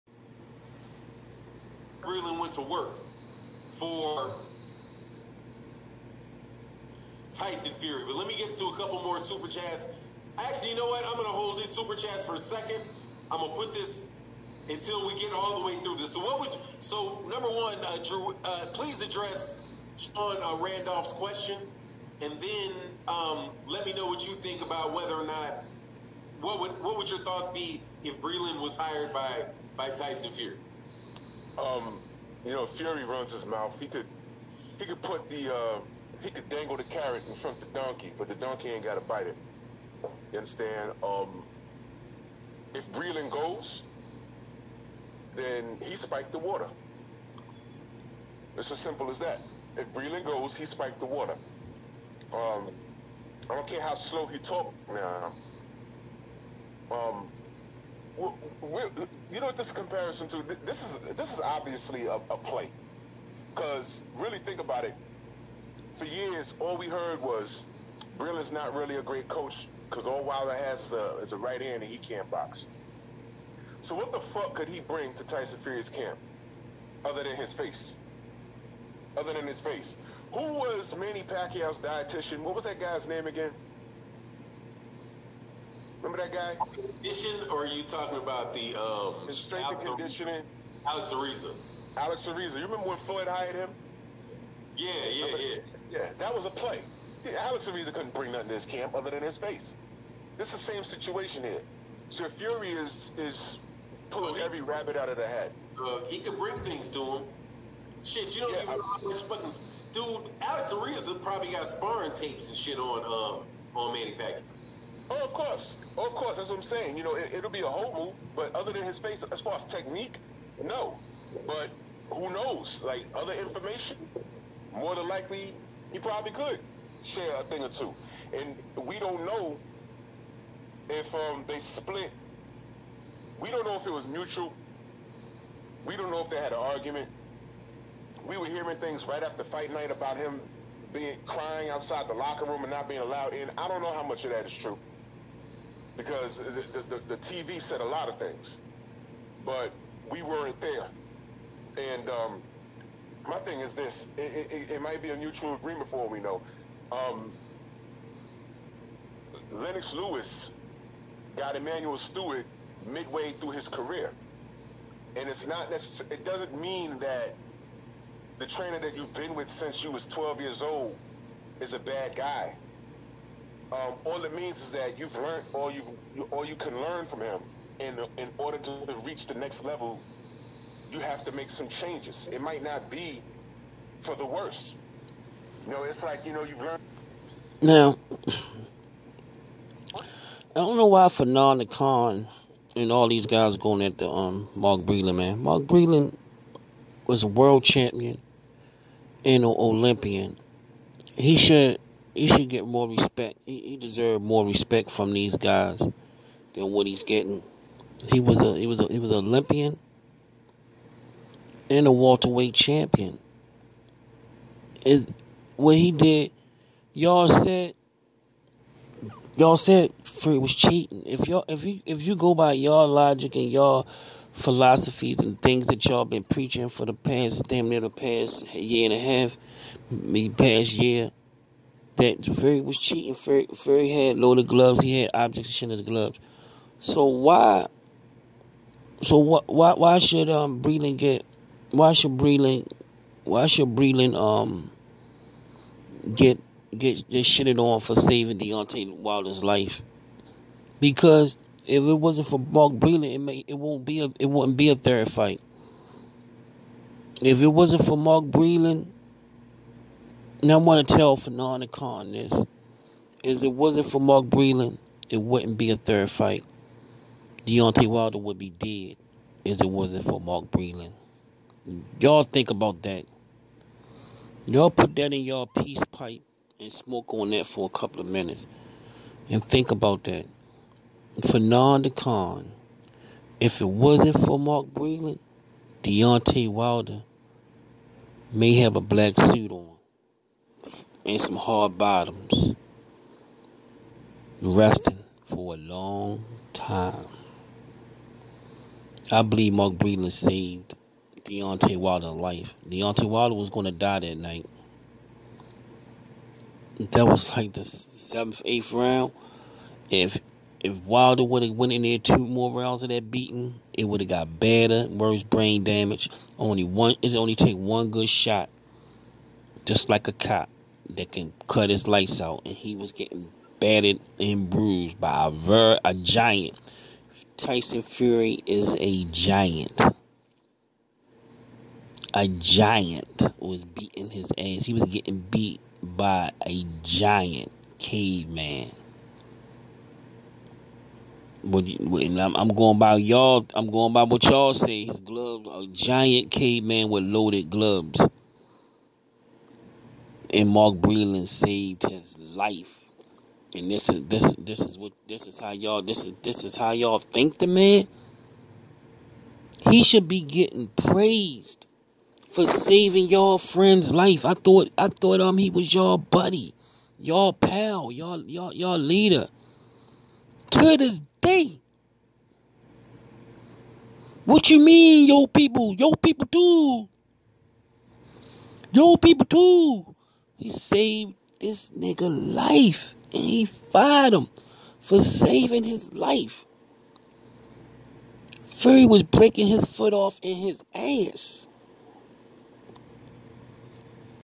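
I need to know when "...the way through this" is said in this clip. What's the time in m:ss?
0:15.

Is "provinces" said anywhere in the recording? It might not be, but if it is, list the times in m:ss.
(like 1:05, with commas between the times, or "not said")
not said.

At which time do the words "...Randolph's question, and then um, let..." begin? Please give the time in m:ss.
0:20.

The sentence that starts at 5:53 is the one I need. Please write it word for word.
And this is this this is what this is how y'all this is this is how y'all think the man.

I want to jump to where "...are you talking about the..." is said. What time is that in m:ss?
1:27.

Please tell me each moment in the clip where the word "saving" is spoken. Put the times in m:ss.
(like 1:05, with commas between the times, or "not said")
4:07, 6:02, 6:24.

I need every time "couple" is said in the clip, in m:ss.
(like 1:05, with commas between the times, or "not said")
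0:08, 4:37.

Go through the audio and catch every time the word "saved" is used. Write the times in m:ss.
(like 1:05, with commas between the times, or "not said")
5:00, 5:51, 6:20.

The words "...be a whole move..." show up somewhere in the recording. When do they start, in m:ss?
1:57.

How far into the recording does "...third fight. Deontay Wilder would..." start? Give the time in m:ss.
4:25.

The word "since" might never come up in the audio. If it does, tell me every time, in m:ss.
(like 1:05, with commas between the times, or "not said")
2:49.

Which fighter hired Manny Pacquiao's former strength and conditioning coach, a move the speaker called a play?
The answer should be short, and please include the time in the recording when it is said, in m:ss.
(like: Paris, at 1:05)
Floyd, at 1:32.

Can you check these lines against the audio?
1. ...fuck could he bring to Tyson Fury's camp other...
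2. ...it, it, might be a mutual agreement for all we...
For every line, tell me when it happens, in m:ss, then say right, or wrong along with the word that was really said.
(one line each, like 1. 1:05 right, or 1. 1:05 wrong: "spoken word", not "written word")
1. 1:14 right
2. 2:34 right.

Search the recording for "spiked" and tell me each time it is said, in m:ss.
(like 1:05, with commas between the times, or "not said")
0:45, 0:50.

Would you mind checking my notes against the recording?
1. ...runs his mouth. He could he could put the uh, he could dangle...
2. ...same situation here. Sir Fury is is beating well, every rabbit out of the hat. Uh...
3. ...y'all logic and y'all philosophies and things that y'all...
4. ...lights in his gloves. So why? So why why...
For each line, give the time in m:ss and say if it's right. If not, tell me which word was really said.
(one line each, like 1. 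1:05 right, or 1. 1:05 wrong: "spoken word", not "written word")
1. 0:33 right
2. 1:40 wrong: "pulling", not "beating"
3. 3:42 right
4. 3:55 wrong: "objects", not "lights".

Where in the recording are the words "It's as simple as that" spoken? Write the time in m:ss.
0:48.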